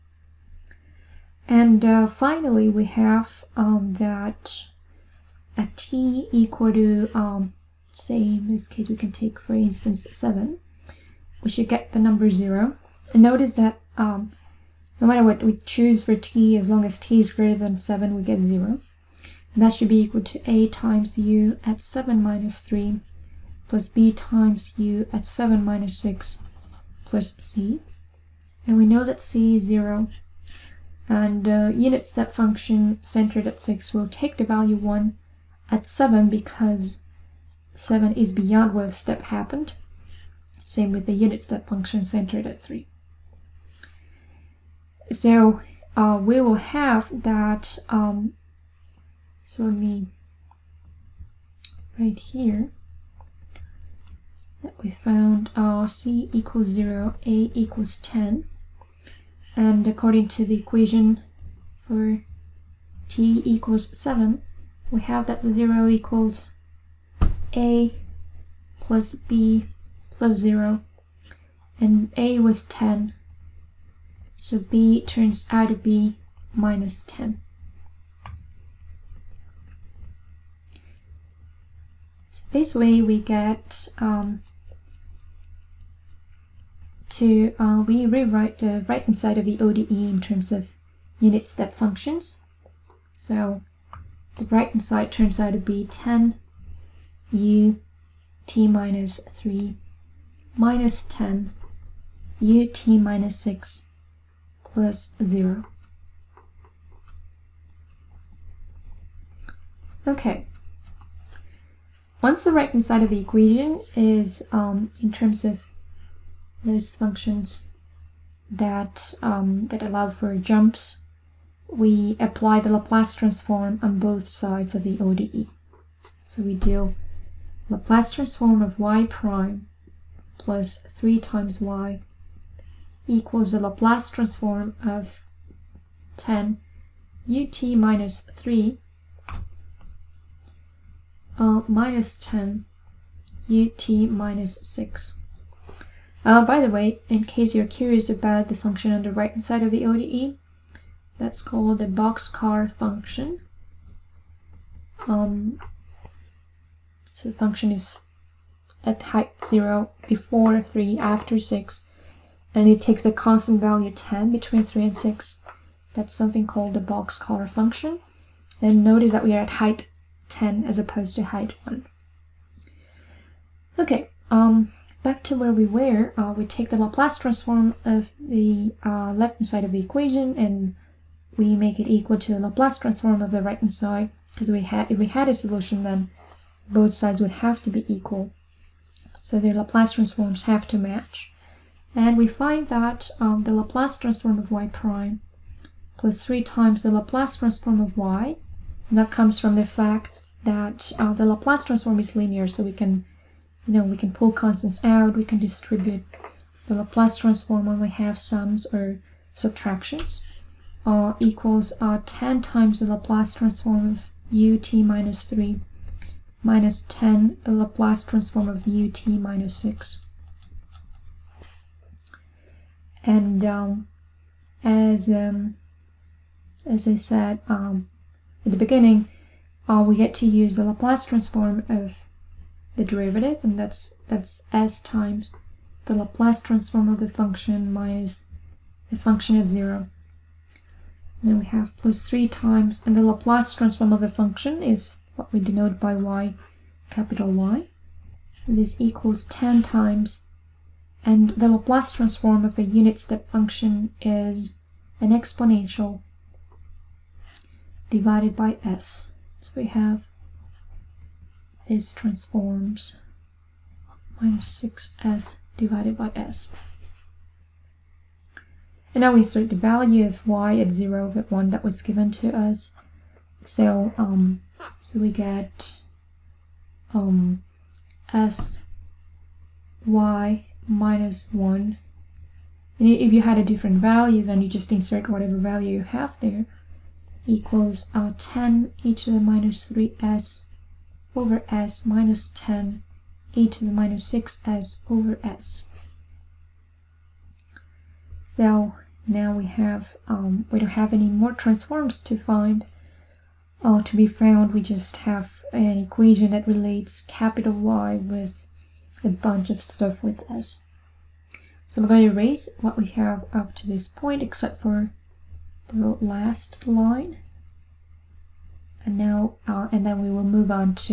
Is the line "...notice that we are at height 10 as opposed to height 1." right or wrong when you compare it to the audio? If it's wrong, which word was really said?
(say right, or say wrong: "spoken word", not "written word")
right.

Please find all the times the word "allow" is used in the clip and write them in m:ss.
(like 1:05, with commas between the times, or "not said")
1:59.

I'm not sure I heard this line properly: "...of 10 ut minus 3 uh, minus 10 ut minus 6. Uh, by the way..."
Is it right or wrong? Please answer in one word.
right.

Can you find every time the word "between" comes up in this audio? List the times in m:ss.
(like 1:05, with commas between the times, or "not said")
2:44.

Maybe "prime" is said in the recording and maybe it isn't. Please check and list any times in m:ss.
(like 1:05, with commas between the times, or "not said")
2:09, 3:14.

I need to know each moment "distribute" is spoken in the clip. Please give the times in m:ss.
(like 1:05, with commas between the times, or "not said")
3:25.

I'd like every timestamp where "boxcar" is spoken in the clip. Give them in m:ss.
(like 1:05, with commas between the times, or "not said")
2:31, 2:46.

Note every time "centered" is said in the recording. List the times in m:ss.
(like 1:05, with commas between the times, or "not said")
0:33, 0:42.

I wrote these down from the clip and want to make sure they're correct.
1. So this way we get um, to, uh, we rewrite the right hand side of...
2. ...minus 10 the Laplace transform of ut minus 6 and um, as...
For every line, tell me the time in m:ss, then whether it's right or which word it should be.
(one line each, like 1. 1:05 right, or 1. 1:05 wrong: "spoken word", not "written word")
1. 1:22 right
2. 3:36 right.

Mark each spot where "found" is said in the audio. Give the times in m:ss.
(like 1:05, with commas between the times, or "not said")
0:54, 5:04.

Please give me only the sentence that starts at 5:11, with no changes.
So we're going to erase what we have up to this point except for the last line.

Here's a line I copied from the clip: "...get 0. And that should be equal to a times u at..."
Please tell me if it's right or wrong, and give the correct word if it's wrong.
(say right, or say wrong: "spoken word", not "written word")
right.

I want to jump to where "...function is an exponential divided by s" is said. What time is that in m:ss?
4:13.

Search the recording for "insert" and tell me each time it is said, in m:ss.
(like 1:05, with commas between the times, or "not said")
4:29, 4:44.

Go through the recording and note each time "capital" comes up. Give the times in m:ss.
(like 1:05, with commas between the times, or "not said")
4:06, 5:07.